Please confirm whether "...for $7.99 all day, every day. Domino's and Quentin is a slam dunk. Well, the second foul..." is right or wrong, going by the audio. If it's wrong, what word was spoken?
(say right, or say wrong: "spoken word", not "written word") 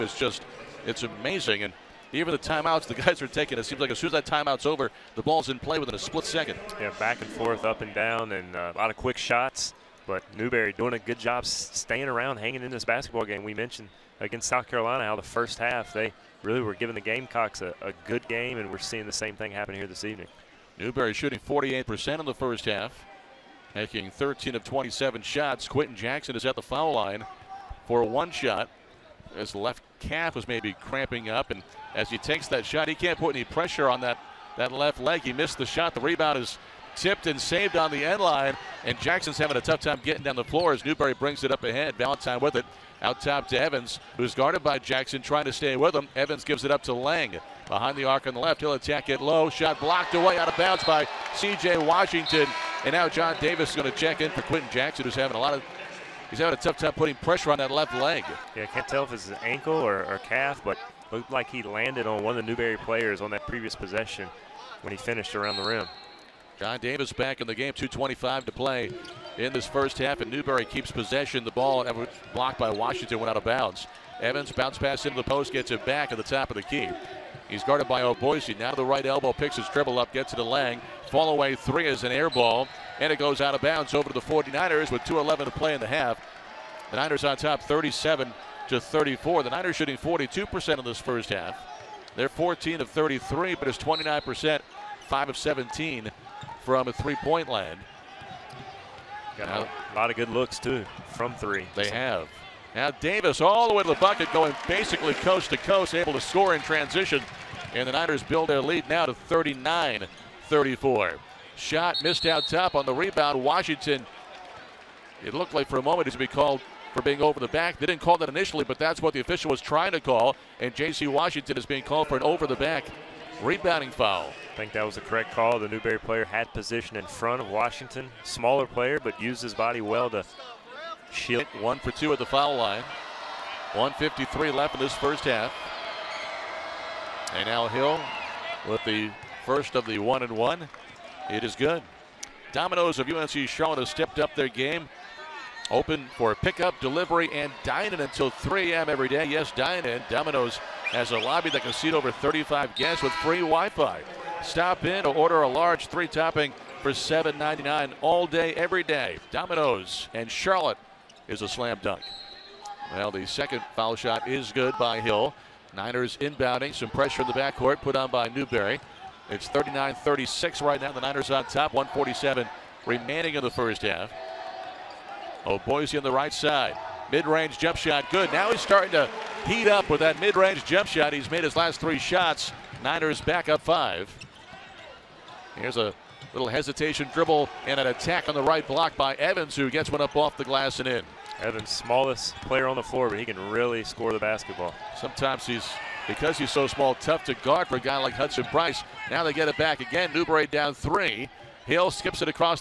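wrong: "Charlotte", not "Quentin".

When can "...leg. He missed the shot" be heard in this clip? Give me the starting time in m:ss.
0:35.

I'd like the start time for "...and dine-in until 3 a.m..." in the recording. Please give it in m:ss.
2:27.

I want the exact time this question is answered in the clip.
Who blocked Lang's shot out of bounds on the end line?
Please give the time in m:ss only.
0:51.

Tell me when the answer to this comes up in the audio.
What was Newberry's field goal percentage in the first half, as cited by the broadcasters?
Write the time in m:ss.
0:21.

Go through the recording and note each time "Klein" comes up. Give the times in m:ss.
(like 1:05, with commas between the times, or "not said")
not said.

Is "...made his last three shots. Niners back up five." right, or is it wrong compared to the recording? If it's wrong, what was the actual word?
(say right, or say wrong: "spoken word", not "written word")
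right.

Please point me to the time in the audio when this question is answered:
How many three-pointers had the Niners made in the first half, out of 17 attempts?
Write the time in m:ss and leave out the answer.
1:35.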